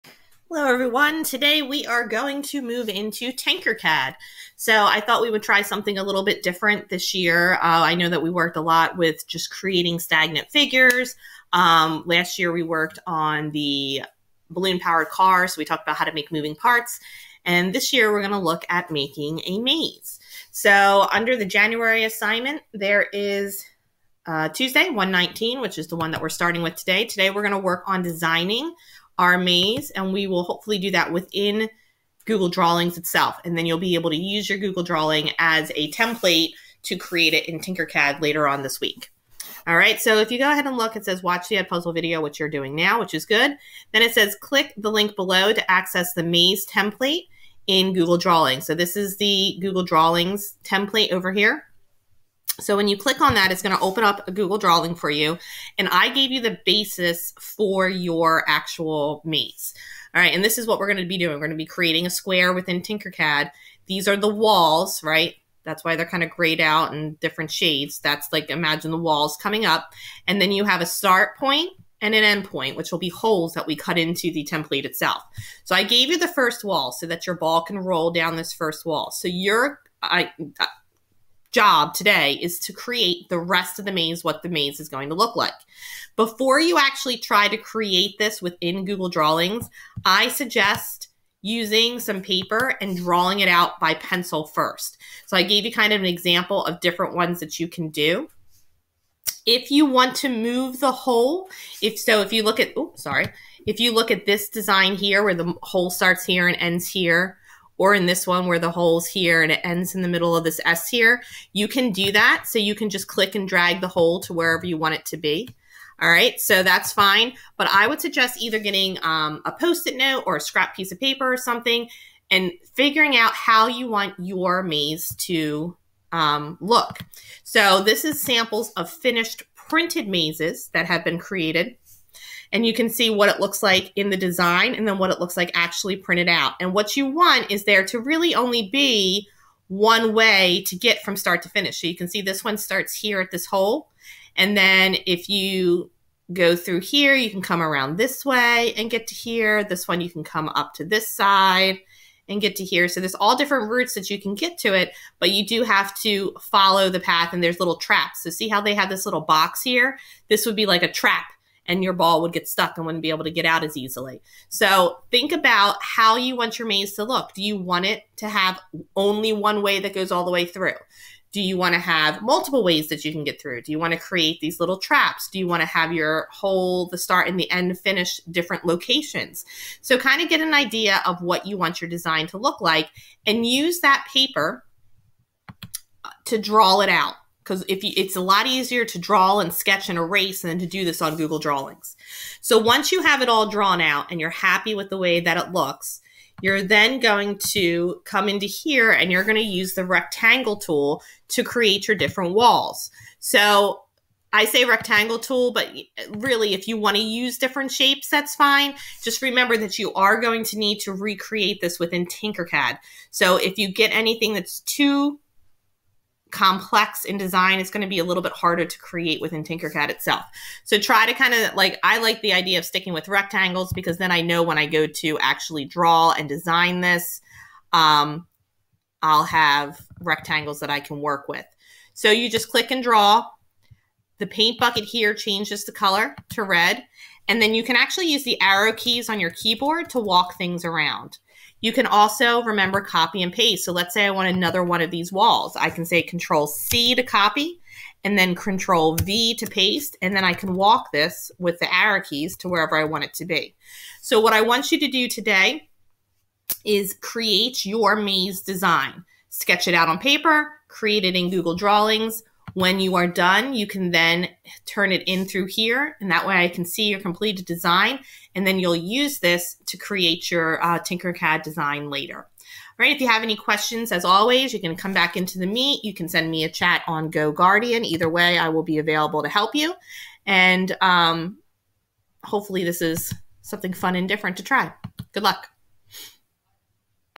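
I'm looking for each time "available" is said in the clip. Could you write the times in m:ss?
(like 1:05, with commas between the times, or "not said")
4:38.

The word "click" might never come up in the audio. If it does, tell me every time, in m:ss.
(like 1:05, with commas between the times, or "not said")
0:44, 0:52, 1:53, 3:52.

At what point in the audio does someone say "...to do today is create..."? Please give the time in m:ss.
4:14.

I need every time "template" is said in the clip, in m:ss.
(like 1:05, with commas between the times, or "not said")
0:35, 0:46, 0:50, 1:14.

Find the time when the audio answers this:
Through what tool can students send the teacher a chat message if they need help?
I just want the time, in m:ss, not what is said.
4:37.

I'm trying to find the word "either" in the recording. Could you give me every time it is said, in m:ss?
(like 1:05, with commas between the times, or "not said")
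1:58, 4:37.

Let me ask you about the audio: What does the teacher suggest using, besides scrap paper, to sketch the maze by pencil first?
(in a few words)
post-it note.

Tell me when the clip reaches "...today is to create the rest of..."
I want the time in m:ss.
1:21.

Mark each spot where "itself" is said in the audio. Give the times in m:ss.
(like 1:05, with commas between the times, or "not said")
0:32, 1:14, 3:39.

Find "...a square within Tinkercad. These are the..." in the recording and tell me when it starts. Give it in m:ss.
1:02.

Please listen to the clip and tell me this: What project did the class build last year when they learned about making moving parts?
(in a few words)
balloon powered car.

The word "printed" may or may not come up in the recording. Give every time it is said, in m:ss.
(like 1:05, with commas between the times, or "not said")
2:09, 2:15.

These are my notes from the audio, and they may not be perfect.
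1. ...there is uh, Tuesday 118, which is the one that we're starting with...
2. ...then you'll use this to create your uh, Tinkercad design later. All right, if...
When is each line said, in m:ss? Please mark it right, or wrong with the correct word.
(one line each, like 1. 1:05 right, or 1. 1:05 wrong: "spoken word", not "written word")
1. 0:22 wrong: "119", not "118"
2. 4:28 right.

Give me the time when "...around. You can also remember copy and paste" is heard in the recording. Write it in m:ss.
4:00.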